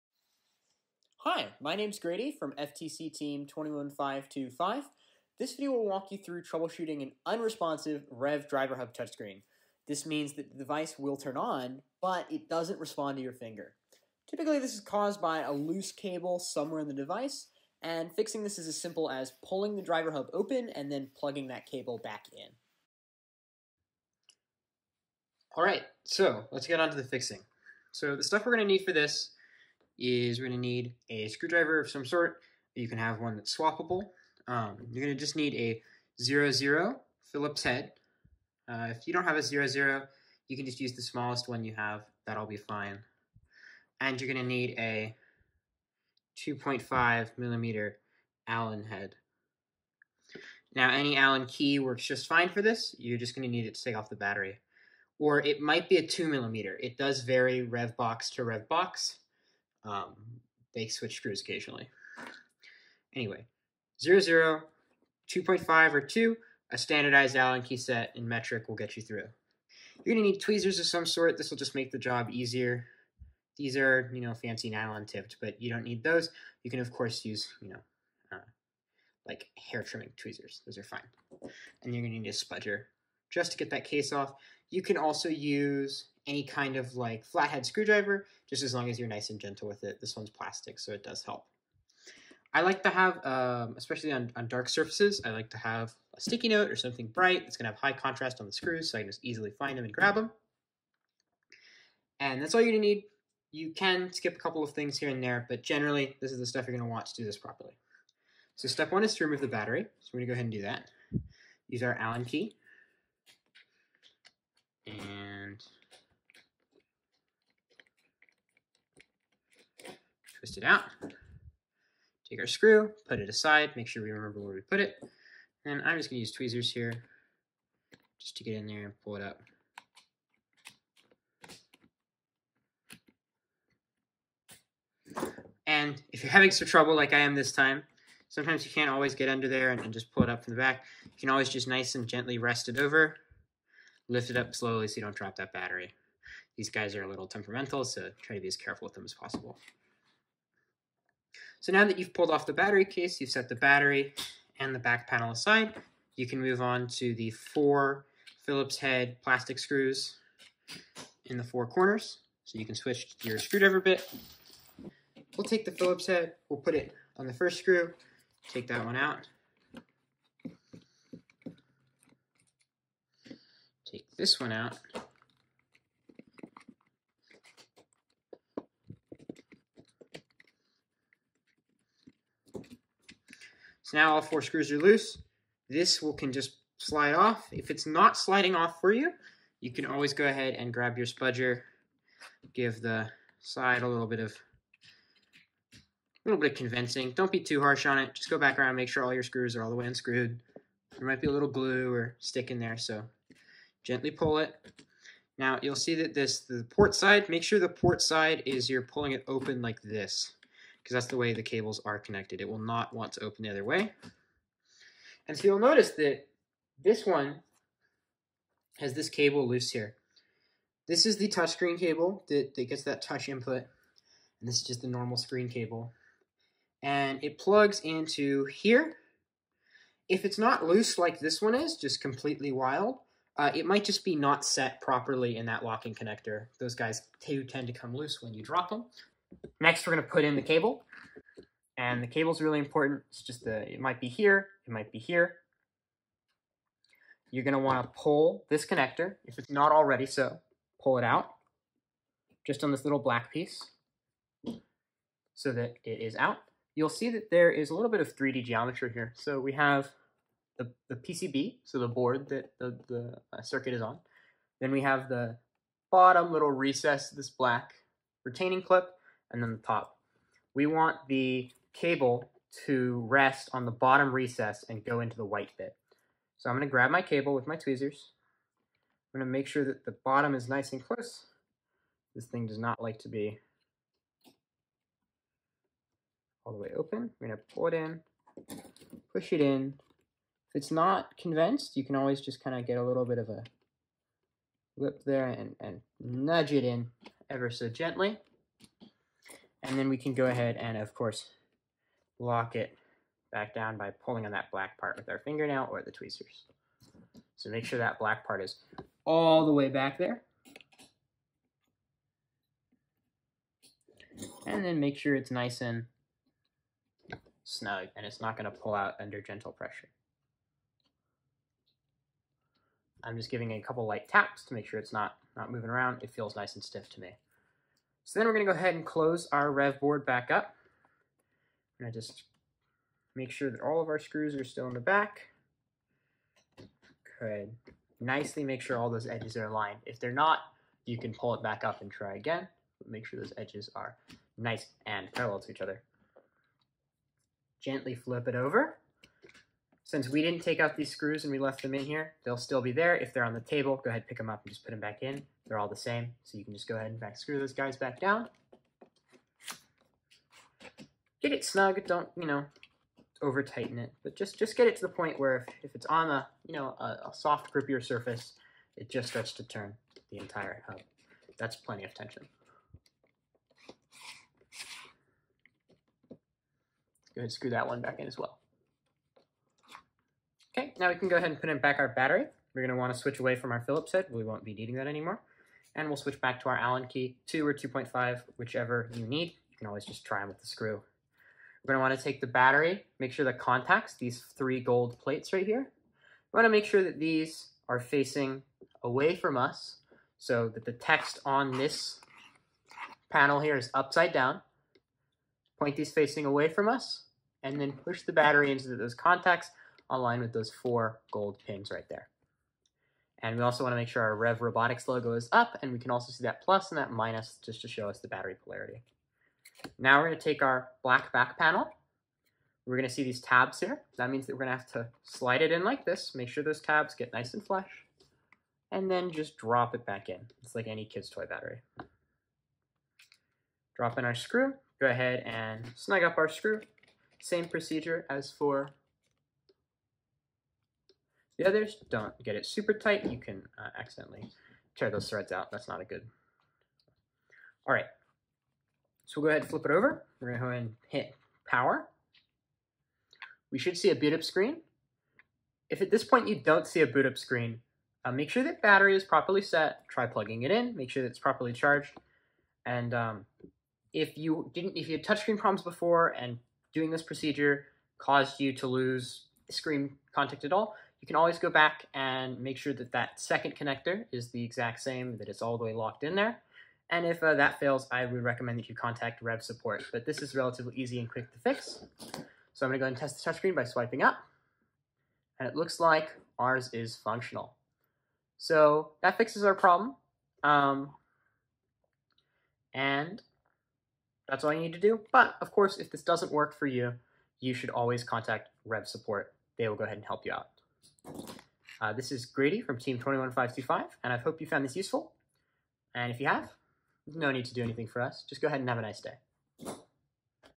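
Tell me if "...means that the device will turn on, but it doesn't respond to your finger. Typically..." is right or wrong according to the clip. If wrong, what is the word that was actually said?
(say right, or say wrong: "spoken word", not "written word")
right.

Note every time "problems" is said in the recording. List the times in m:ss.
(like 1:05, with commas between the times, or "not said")
7:45, 8:09.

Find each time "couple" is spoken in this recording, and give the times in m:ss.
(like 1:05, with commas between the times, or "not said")
1:44, 5:23.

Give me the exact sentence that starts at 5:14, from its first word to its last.
And then make sure it's nice and snug and it's not going to pull out under gentle pressure.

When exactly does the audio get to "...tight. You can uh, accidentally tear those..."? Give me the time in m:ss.
7:22.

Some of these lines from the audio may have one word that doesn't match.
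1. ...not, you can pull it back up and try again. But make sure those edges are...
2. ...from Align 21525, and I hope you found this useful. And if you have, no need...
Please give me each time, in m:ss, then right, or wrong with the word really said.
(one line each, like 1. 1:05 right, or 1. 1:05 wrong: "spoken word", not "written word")
1. 5:40 right
2. 8:22 wrong: "Team", not "Align".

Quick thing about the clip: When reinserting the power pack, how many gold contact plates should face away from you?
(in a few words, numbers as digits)
three.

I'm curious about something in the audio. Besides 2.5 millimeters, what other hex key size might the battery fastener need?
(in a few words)
2 millimeter.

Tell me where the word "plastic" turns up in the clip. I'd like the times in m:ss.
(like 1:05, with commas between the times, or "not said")
1:30, 2:39.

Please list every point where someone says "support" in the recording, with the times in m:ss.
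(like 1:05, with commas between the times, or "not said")
7:59, 8:18.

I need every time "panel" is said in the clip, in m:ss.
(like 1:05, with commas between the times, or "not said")
2:35, 6:43, 7:01.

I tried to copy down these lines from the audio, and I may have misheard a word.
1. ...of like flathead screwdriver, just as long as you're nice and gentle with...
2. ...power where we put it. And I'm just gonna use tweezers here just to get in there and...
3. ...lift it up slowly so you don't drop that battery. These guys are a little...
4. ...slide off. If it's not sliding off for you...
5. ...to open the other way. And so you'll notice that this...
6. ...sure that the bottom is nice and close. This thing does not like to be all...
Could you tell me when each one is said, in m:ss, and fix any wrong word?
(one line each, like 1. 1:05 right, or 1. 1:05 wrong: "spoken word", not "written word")
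1. 1:26 right
2. 2:04 wrong: "remember", not "power"
3. 2:24 right
4. 3:06 right
5. 3:33 right
6. 4:39 right.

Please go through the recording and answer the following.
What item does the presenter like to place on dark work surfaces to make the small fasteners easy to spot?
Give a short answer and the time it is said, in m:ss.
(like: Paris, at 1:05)
sticky note, at 1:36.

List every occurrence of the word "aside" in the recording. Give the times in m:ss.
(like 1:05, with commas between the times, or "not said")
2:03, 2:35.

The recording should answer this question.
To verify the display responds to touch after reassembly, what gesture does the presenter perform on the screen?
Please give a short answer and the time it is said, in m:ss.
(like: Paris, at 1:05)
swiping up, at 8:03.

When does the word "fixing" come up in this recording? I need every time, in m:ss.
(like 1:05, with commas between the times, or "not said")
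0:18, 0:27.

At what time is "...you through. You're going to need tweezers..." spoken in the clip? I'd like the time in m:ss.
1:08.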